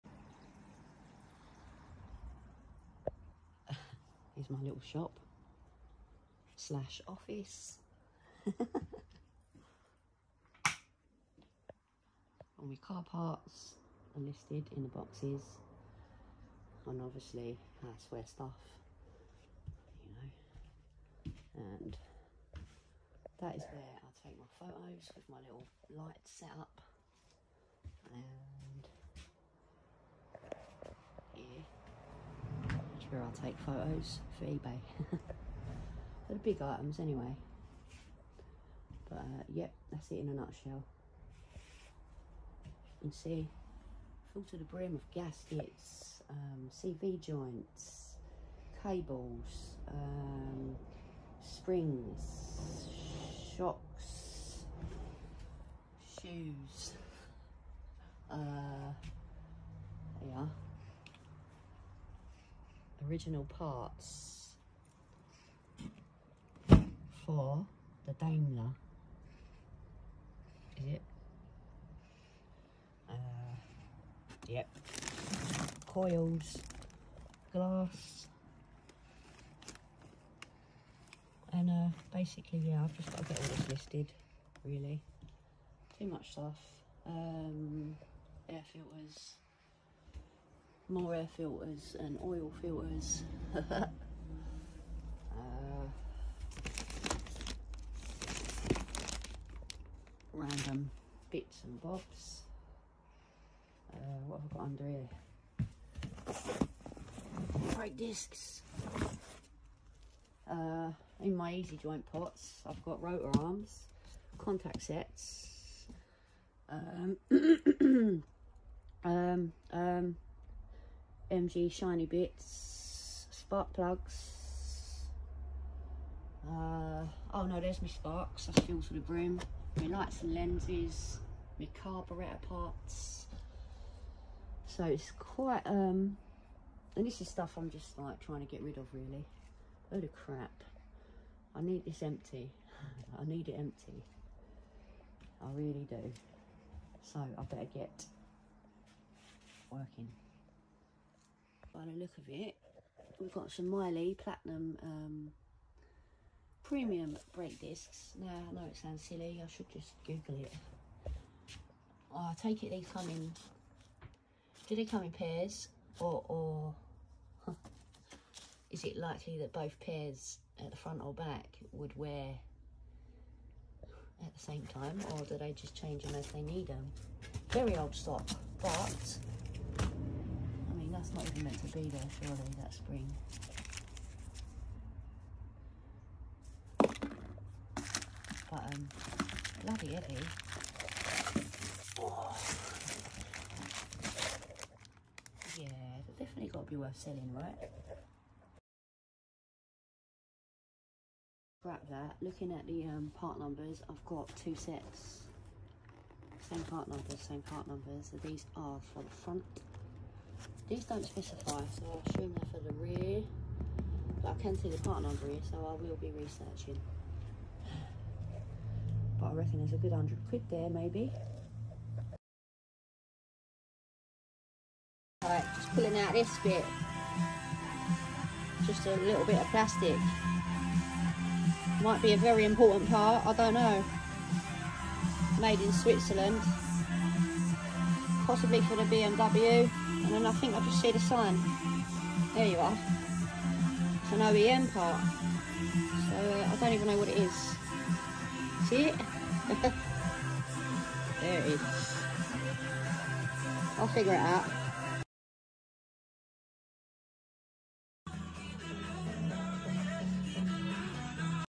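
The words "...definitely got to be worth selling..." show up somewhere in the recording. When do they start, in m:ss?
3:16.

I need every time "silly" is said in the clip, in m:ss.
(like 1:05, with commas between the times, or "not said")
2:39.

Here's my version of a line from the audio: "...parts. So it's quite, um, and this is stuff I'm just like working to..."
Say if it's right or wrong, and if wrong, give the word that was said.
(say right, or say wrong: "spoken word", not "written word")
wrong: "trying", not "working".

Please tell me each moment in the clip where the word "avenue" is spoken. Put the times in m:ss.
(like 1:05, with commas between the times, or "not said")
not said.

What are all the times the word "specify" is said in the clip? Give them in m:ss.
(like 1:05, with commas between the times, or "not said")
3:31.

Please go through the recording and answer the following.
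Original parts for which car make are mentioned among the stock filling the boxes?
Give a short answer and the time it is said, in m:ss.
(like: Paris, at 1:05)
Daimler, at 1:08.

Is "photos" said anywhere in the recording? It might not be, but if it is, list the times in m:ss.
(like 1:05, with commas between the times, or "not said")
0:24, 0:33.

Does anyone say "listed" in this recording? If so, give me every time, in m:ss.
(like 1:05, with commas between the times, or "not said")
0:14, 1:23.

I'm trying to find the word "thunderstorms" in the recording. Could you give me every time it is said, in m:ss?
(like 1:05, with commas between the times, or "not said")
not said.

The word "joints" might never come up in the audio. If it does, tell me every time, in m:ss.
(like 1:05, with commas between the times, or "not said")
0:47, 1:51.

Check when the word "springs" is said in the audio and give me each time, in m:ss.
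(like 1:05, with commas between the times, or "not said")
0:51, 3:02.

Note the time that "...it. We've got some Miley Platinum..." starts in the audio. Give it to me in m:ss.
2:32.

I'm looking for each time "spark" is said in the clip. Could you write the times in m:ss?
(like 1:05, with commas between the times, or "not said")
2:03, 2:07.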